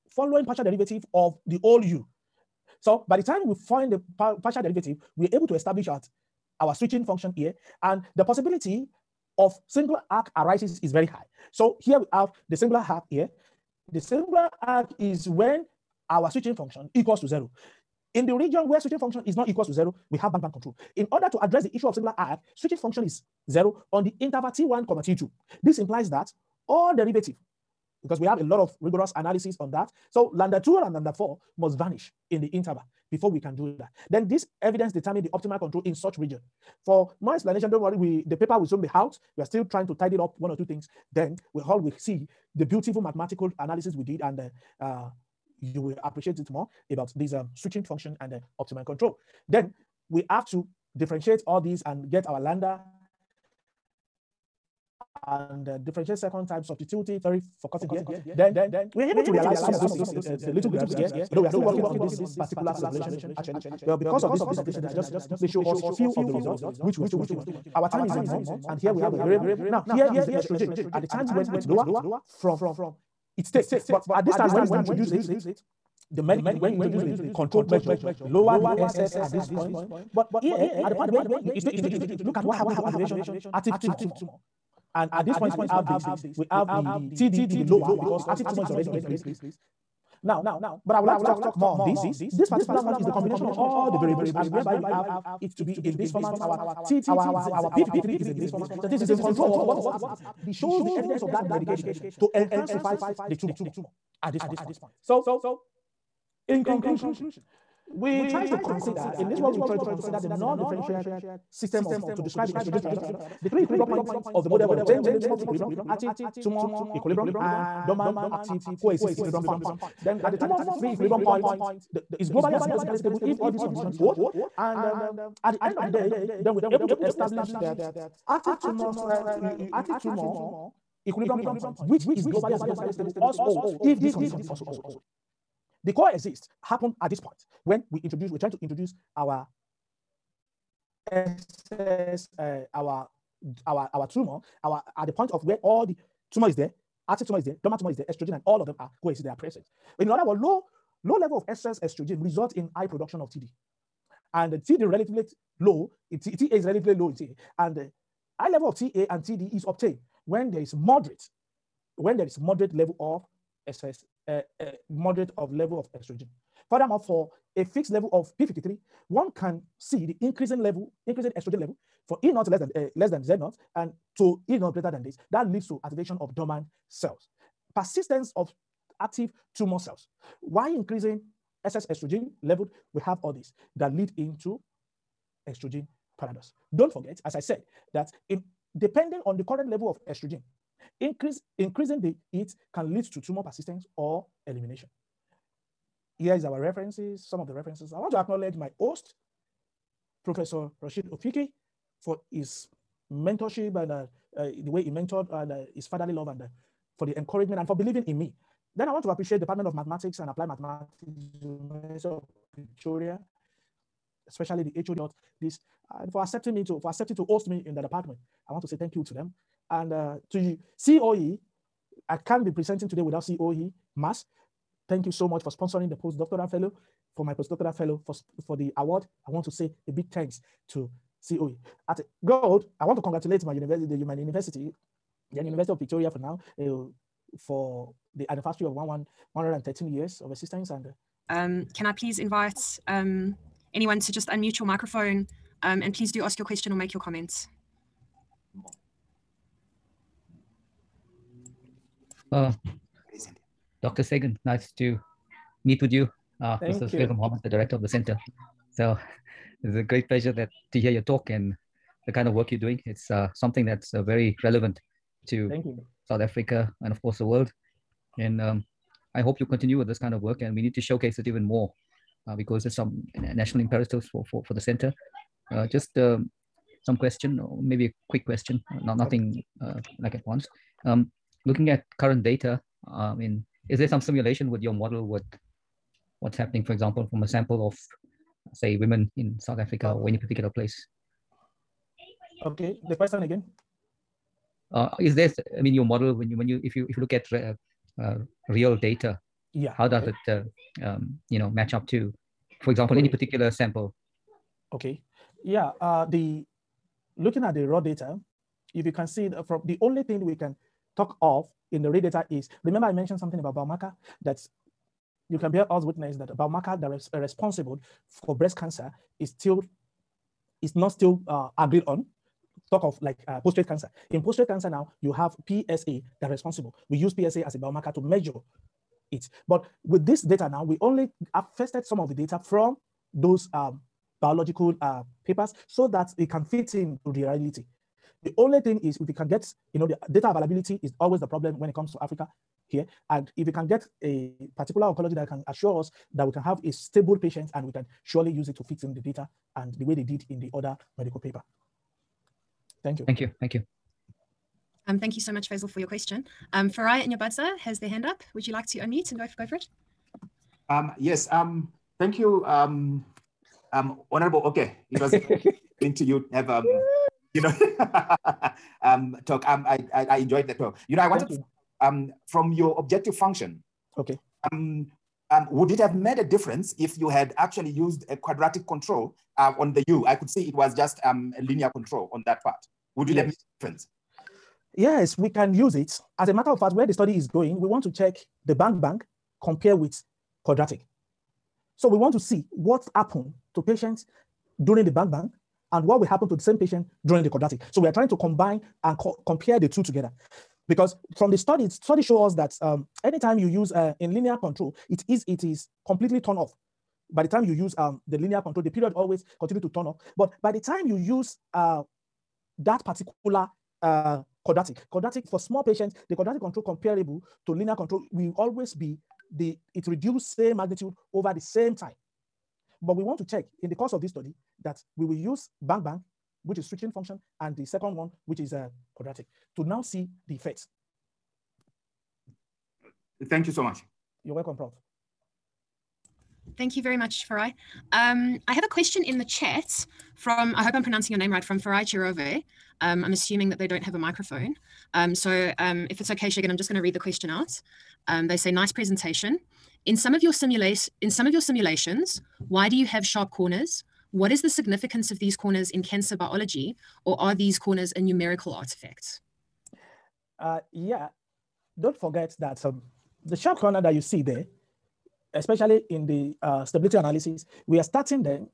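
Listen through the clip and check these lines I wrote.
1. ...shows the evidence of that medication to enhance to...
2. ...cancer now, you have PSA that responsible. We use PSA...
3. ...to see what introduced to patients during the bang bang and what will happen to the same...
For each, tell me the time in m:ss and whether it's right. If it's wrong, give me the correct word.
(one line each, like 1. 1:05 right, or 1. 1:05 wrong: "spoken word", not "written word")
1. 1:40 right
2. 5:24 right
3. 6:32 wrong: "happened", not "introduced".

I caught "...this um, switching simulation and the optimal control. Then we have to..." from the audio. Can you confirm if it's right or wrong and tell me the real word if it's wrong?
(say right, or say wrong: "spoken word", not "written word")
wrong: "function", not "simulation".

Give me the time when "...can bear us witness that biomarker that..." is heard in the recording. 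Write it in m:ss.
5:15.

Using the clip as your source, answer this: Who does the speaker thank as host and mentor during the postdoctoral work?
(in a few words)
Professor Rachid Ouifki.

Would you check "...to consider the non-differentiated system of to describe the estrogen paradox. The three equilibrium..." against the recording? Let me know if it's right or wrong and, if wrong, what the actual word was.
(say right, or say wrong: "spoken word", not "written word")
right.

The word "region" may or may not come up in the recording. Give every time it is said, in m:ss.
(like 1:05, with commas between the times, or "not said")
0:18, 0:36.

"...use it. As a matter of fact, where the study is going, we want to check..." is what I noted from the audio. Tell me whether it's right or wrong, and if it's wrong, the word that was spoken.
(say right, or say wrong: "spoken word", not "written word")
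right.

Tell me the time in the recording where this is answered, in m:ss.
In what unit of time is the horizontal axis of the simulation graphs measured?
1:08.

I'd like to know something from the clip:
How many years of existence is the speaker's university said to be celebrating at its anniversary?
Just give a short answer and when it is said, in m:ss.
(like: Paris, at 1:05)
113, at 3:59.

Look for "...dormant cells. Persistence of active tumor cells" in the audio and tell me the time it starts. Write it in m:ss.
2:56.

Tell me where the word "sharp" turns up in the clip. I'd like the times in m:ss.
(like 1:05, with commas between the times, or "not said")
7:33, 7:43.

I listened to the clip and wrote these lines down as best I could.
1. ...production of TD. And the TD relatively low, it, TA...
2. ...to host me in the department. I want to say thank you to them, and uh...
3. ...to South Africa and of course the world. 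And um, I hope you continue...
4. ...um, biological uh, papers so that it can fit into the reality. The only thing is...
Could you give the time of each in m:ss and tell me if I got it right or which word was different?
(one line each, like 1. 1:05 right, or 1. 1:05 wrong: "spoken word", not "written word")
1. 2:32 right
2. 3:37 right
3. 4:25 right
4. 5:33 right.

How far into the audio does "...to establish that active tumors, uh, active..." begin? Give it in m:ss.
2:06.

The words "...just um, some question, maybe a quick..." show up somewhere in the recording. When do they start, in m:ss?
4:35.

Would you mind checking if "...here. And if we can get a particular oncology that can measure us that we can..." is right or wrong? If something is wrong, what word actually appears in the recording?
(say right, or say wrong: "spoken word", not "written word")
wrong: "assure", not "measure".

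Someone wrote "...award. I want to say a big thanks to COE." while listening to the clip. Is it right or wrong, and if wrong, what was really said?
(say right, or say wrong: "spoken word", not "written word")
right.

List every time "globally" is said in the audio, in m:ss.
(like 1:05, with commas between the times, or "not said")
2:02, 2:12.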